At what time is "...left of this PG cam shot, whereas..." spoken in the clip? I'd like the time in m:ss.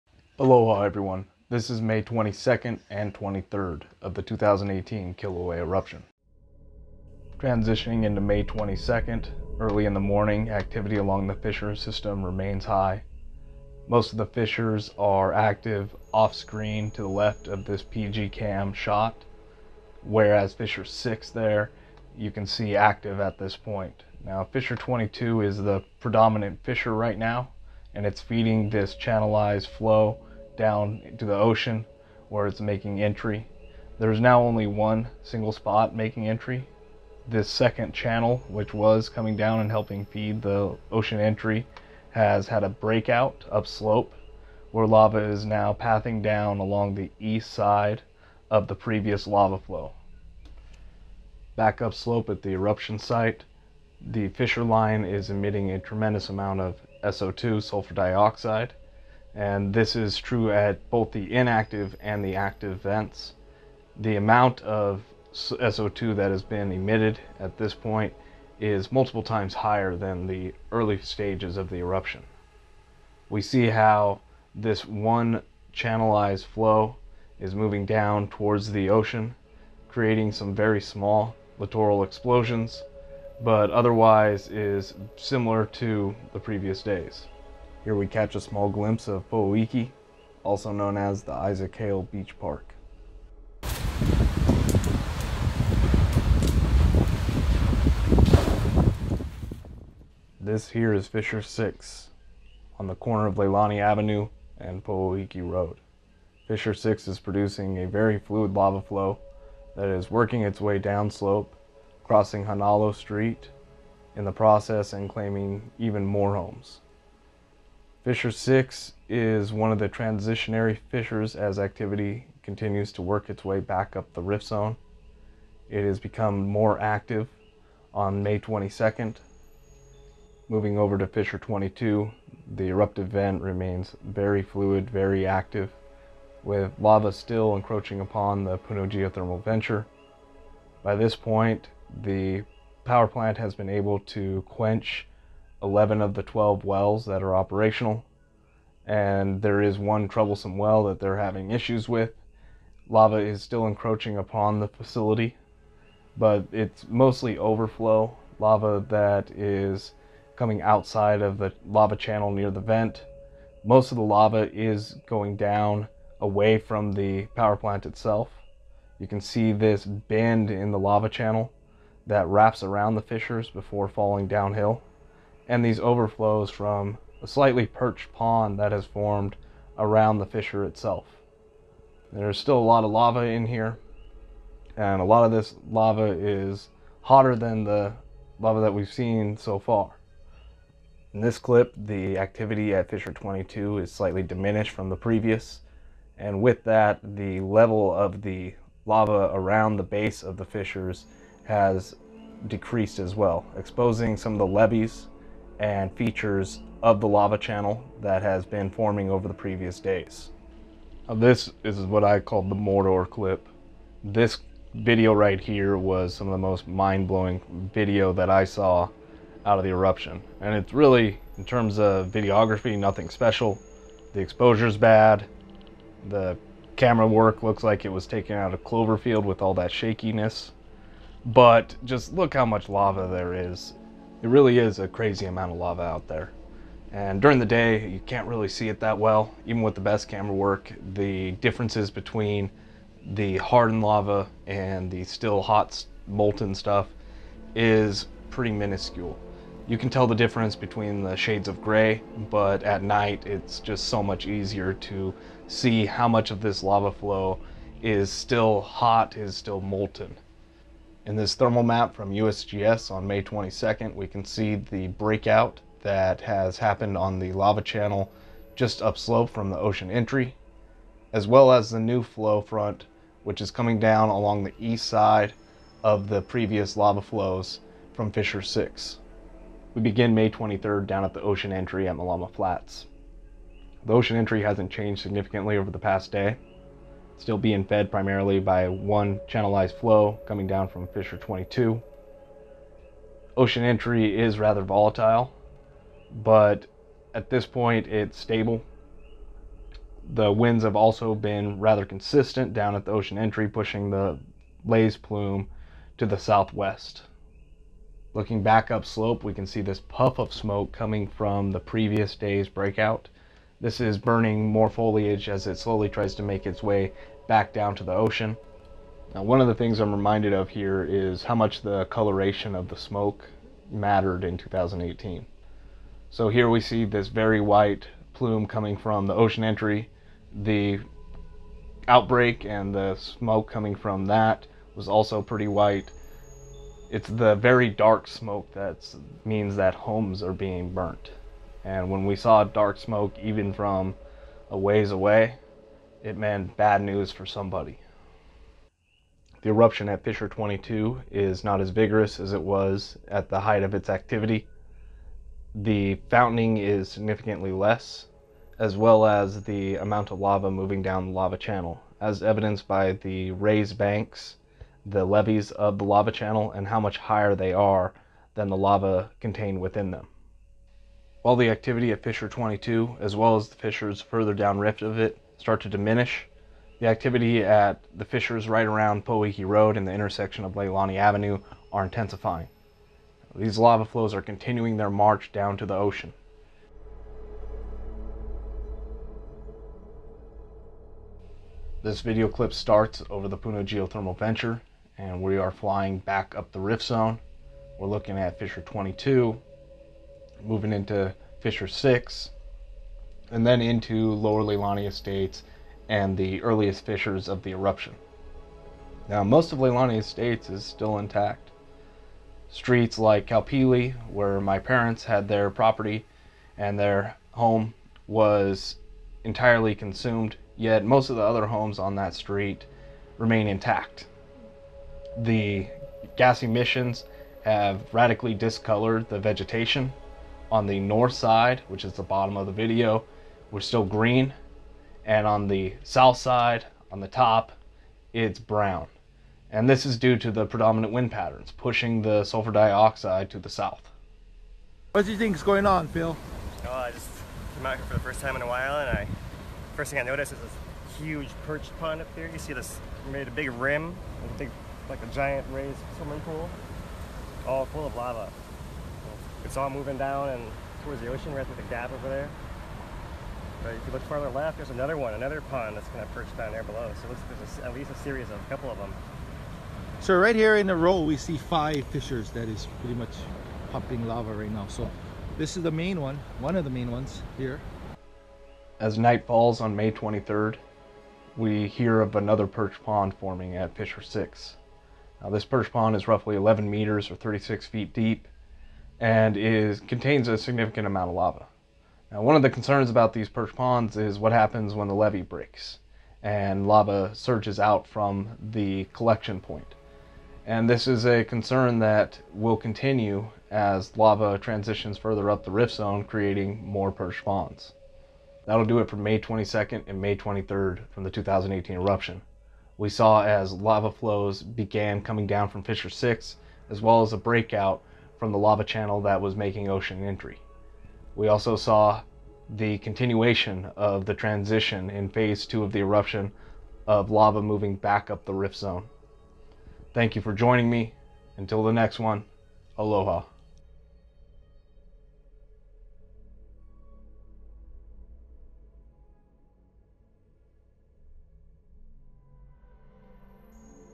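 0:17.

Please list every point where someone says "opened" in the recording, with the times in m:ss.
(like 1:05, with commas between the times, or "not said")
not said.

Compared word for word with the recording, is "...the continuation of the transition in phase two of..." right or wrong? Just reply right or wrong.
right.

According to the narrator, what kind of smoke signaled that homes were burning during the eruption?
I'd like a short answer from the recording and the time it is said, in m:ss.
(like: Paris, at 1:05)
very dark, at 5:37.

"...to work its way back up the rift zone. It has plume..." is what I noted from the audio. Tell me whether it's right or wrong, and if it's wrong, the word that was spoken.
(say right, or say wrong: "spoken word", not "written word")
wrong: "become", not "plume".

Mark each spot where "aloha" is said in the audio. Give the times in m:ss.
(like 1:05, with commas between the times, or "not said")
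0:00, 8:52.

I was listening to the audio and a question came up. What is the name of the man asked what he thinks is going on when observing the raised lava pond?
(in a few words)
Phil.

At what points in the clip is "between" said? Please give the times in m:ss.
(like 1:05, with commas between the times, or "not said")
4:01, 4:10.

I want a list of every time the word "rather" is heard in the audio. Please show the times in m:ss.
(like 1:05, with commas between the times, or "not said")
4:54, 5:01.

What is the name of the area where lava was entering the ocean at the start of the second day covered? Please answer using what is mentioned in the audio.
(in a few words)
Malama Flats.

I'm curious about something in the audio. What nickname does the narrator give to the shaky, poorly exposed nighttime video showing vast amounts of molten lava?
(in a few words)
the Mordor clip.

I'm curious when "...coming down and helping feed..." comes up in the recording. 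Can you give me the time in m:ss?
0:39.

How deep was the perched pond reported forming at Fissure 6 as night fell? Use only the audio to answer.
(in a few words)
11 meters.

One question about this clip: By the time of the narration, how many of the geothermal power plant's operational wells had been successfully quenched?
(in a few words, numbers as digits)
11.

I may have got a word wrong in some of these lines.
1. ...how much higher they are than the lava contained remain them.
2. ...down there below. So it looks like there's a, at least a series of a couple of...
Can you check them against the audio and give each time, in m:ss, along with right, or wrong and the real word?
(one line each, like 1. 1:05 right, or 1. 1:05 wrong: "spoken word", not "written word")
1. 6:06 wrong: "within", not "remain"
2. 7:46 right.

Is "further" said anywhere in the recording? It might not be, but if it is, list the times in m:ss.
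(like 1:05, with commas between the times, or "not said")
6:14, 8:24.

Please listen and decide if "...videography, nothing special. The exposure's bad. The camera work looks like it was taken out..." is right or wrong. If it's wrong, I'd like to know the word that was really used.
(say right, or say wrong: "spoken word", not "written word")
right.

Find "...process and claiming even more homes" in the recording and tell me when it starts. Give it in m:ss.
1:54.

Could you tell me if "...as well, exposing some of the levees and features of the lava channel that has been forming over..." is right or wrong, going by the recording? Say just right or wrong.
right.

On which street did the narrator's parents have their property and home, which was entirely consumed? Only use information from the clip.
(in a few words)
Kaupili.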